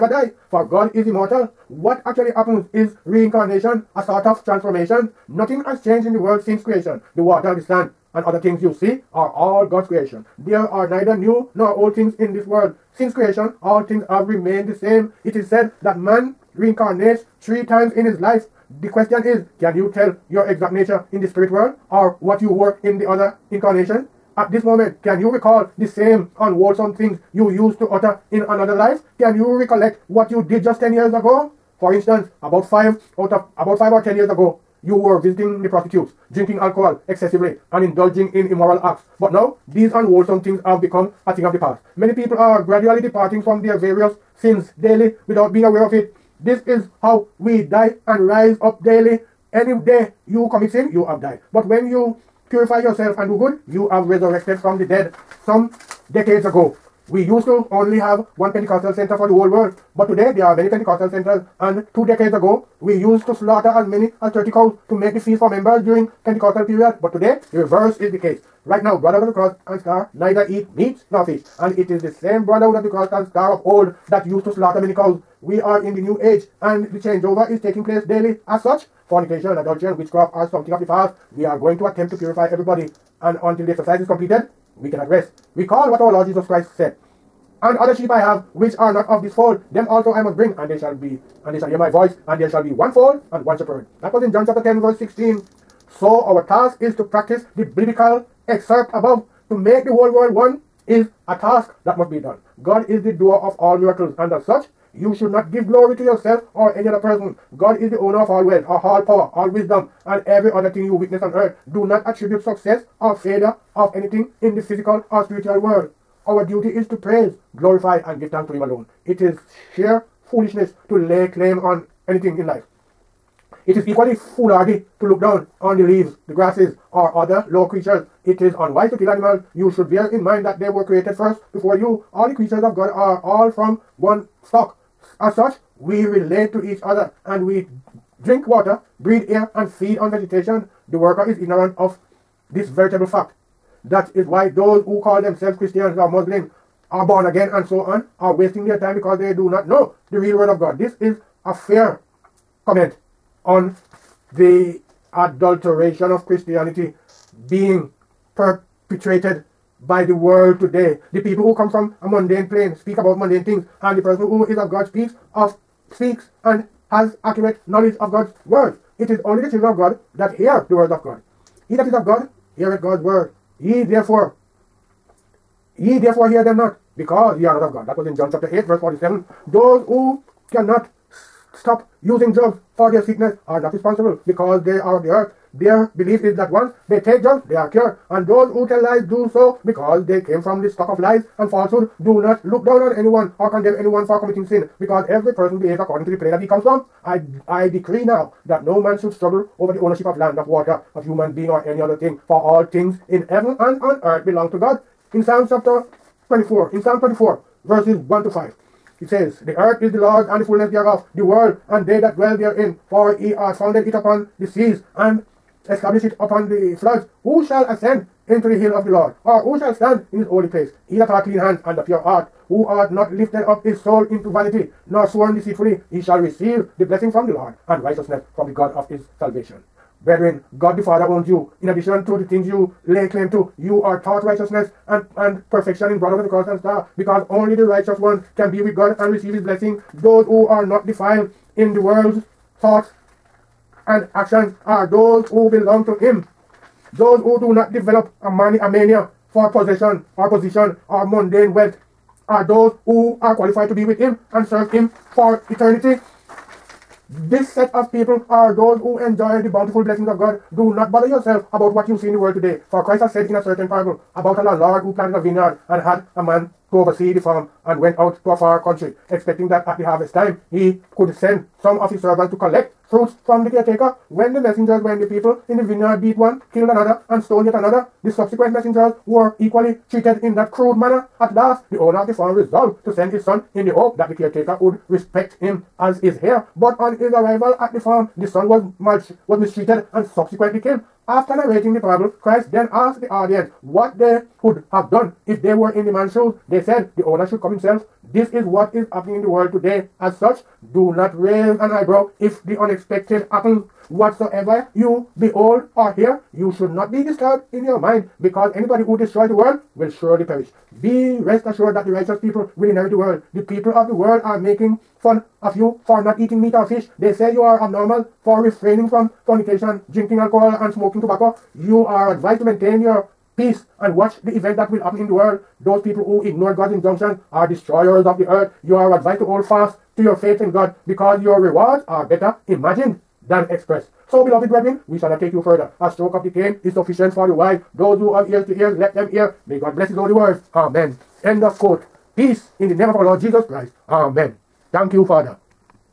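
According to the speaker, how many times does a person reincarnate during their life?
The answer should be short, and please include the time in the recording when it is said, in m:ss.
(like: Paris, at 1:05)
3, at 0:17.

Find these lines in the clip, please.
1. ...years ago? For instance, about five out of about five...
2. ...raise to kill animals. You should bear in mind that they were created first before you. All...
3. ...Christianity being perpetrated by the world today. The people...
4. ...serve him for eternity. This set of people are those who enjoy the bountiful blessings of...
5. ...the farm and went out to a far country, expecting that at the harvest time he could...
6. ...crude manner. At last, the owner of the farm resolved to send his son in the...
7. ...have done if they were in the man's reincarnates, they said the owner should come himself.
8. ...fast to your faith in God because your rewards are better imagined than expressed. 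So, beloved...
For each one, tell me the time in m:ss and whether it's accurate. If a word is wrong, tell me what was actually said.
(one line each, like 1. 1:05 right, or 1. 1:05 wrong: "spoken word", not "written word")
1. 0:30 right
2. 2:08 wrong: "unwise", not "raise"
3. 2:36 right
4. 4:14 right
5. 4:27 right
6. 4:40 right
7. 4:54 wrong: "shoes", not "reincarnates"
8. 5:29 right.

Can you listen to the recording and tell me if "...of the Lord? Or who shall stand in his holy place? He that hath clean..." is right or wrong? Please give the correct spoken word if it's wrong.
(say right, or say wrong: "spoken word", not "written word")
right.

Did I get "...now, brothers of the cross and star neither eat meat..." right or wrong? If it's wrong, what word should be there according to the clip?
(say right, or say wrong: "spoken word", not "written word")
right.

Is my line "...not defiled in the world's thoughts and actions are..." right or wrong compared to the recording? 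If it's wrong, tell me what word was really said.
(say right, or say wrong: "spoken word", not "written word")
right.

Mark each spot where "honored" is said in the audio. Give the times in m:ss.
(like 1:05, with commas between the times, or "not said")
not said.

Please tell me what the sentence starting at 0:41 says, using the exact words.
Many people are gradually departing from their various sins daily without being aware of it.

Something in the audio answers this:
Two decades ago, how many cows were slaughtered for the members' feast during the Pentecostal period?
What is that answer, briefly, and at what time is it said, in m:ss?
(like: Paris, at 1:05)
30, at 1:04.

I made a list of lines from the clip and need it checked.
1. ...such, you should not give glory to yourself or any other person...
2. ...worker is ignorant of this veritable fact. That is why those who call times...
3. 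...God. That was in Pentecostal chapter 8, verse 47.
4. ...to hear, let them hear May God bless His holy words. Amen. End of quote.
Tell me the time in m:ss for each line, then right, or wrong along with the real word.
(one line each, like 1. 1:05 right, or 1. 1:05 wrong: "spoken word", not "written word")
1. 1:44 right
2. 2:20 wrong: "themselves", not "times"
3. 2:57 wrong: "John", not "Pentecostal"
4. 5:38 right.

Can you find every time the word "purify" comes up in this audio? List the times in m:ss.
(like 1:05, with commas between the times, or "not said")
0:52, 1:22.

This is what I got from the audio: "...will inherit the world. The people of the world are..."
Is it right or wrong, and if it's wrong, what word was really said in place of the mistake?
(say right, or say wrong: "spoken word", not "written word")
right.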